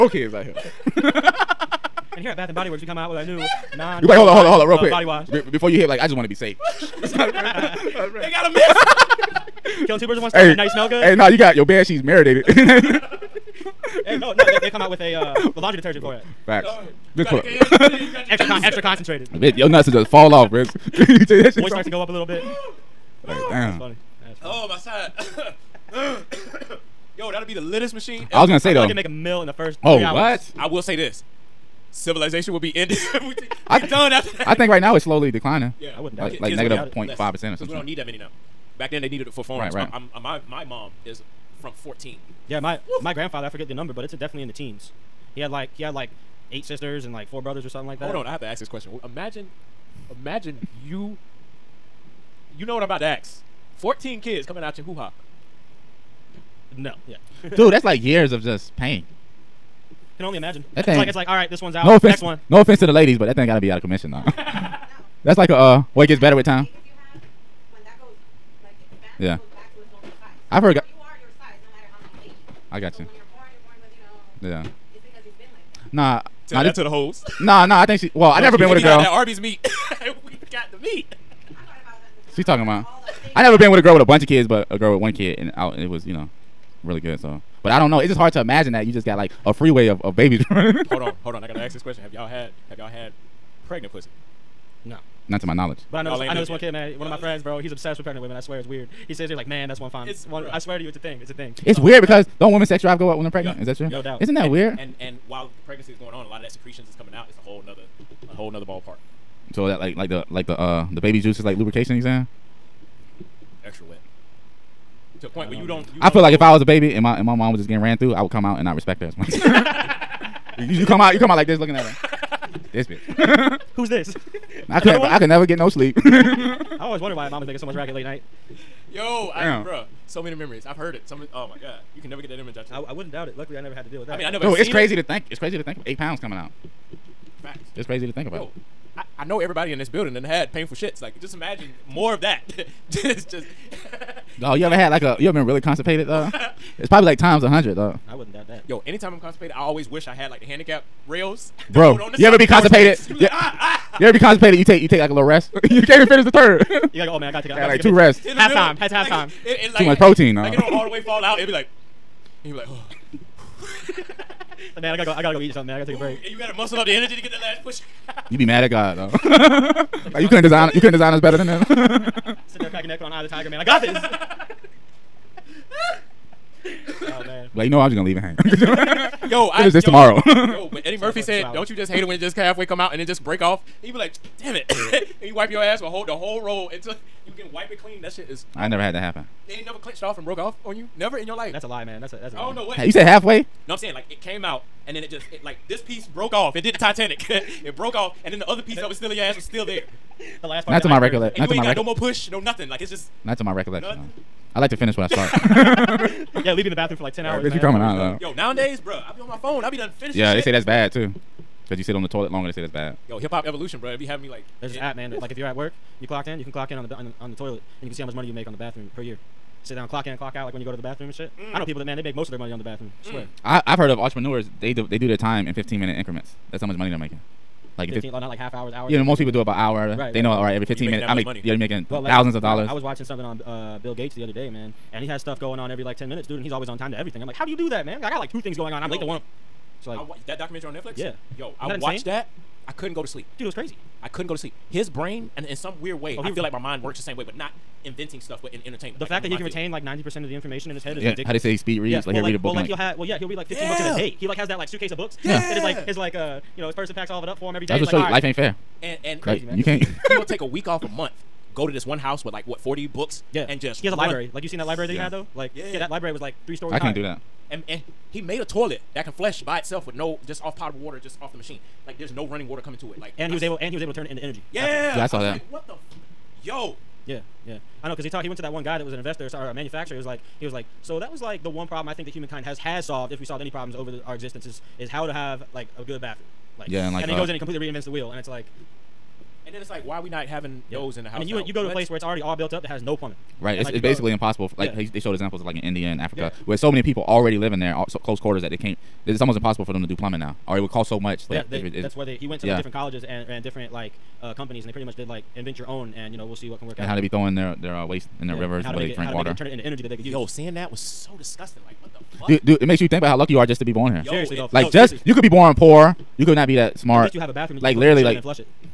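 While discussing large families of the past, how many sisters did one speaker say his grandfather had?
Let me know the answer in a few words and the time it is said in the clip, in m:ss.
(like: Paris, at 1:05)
8, at 0:46.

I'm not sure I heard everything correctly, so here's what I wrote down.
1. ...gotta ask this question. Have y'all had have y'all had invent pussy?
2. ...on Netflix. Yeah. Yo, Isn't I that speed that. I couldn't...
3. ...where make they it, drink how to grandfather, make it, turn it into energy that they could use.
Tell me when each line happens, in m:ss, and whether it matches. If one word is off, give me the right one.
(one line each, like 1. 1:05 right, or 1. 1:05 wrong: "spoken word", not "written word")
1. 1:31 wrong: "pregnant", not "invent"
2. 4:00 wrong: "watched", not "speed"
3. 5:08 wrong: "water", not "grandfather".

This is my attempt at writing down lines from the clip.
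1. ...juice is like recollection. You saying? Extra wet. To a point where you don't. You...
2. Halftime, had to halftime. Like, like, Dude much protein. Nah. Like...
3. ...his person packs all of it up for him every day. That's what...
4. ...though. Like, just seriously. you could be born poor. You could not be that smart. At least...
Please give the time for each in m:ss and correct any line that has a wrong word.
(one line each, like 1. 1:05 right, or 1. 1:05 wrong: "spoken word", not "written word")
1. 1:51 wrong: "lubrication", not "recollection"
2. 2:38 wrong: "Too", not "Dude"
3. 4:16 right
4. 5:14 right.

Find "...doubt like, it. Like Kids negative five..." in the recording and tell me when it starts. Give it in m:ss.
0:36.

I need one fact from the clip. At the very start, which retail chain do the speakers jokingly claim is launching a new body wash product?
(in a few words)
Bath and Body Works.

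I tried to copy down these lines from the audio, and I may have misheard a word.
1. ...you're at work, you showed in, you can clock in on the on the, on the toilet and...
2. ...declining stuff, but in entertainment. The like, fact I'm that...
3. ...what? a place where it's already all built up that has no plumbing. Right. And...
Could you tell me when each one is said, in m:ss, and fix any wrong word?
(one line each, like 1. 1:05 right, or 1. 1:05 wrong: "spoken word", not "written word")
1. 3:35 wrong: "clocked", not "showed"
2. 4:07 wrong: "inventing", not "declining"
3. 4:51 right.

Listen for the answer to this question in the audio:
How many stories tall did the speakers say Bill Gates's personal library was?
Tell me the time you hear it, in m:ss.
4:26.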